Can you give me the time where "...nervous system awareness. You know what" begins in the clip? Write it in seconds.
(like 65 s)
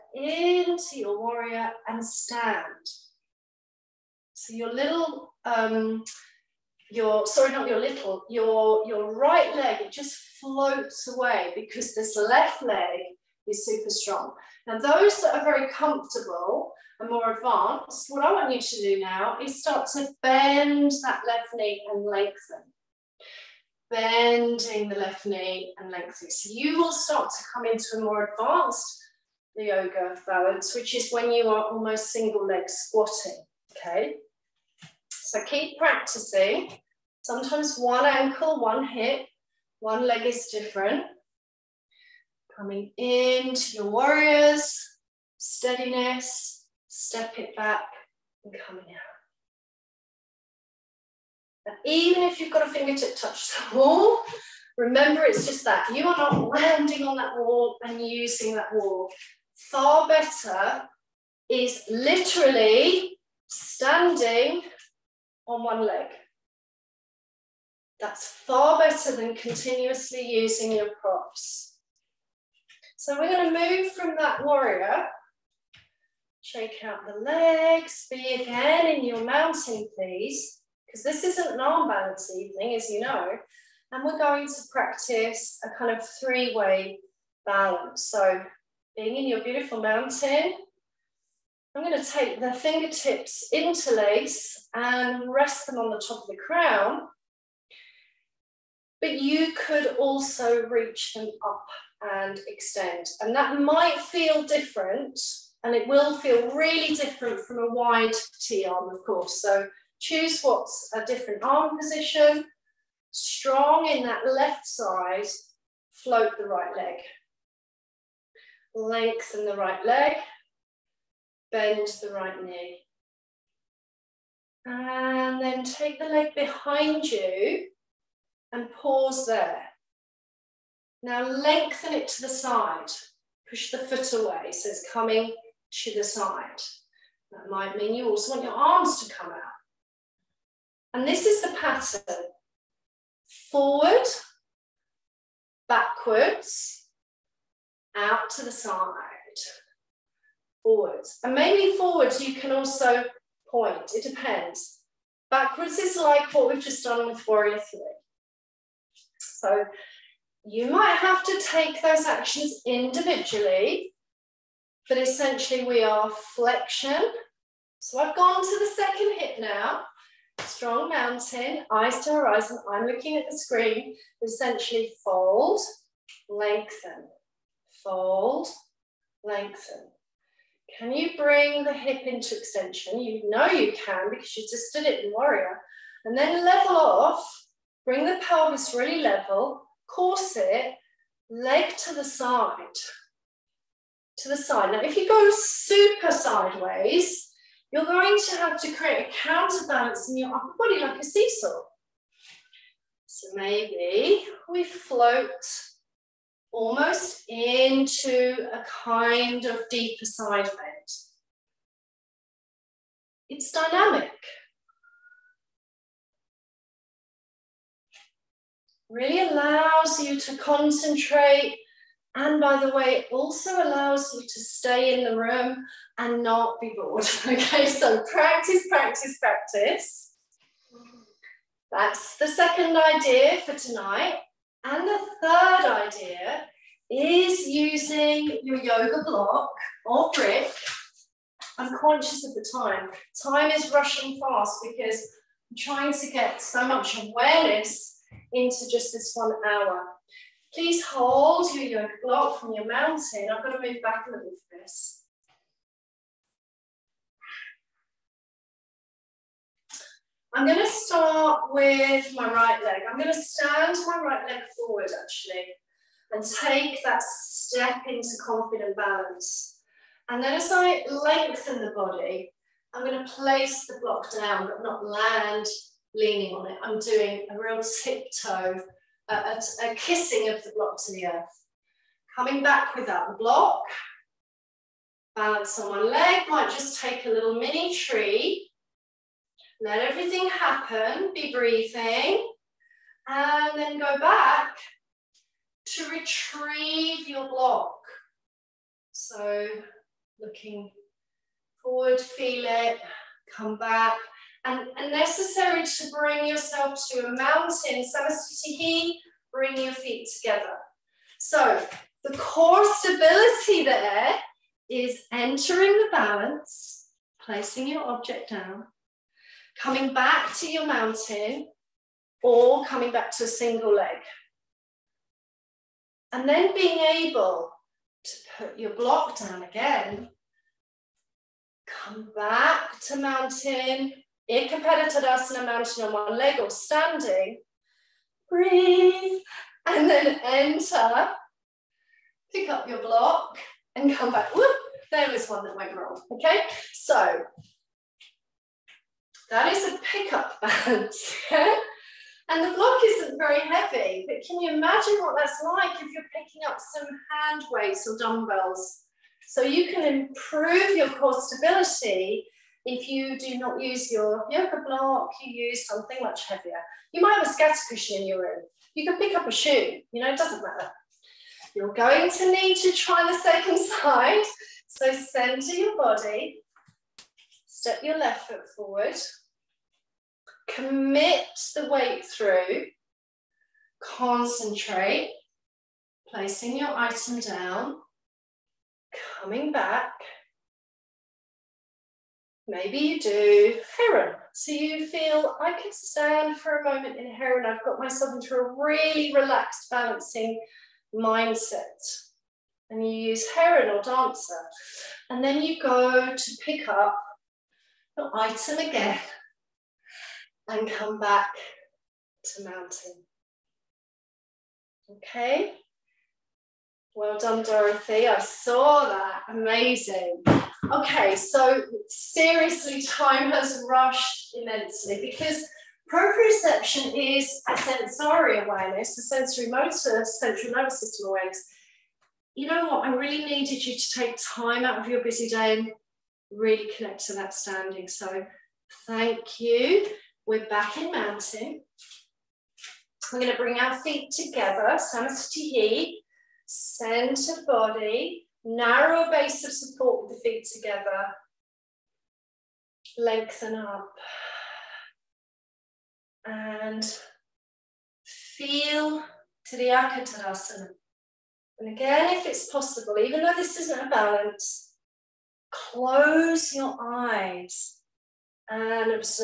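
430 s.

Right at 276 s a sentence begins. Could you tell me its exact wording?
I'm doing a real tiptoe, a, a, a kissing of the block to the earth.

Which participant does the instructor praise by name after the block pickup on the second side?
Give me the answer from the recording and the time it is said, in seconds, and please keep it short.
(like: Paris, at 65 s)
Dorothy, at 417 s.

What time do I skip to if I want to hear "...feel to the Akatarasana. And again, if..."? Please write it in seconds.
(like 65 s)
458 s.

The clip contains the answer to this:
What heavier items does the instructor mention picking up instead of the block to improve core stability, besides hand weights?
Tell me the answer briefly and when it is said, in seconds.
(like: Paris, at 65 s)
Dumbbells, at 357 s.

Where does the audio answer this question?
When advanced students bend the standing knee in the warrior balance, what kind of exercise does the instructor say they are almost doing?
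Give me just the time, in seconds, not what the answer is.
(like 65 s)
32 s.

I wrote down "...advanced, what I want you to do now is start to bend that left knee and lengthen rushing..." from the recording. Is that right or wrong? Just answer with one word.
wrong.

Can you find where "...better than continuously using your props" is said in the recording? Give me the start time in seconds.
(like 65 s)
68 s.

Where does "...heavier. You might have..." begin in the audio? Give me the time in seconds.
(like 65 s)
366 s.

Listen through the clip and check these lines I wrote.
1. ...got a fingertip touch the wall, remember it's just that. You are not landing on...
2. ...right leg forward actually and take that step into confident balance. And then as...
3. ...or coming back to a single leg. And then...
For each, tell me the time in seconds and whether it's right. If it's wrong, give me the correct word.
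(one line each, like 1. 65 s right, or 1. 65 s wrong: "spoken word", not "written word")
1. 52 s right
2. 264 s right
3. 322 s right.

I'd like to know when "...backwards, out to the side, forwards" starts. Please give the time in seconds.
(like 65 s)
145 s.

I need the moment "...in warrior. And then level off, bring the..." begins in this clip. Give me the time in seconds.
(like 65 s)
185 s.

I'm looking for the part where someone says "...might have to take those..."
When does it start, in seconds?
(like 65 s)
160 s.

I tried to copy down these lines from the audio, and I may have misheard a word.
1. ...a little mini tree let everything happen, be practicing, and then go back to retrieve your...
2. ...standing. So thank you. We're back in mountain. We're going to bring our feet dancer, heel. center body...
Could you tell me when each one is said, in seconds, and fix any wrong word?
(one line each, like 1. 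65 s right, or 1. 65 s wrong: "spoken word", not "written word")
1. 287 s wrong: "breathing", not "practicing"
2. 437 s wrong: "together", not "dancer".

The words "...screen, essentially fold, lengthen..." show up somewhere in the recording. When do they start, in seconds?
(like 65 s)
173 s.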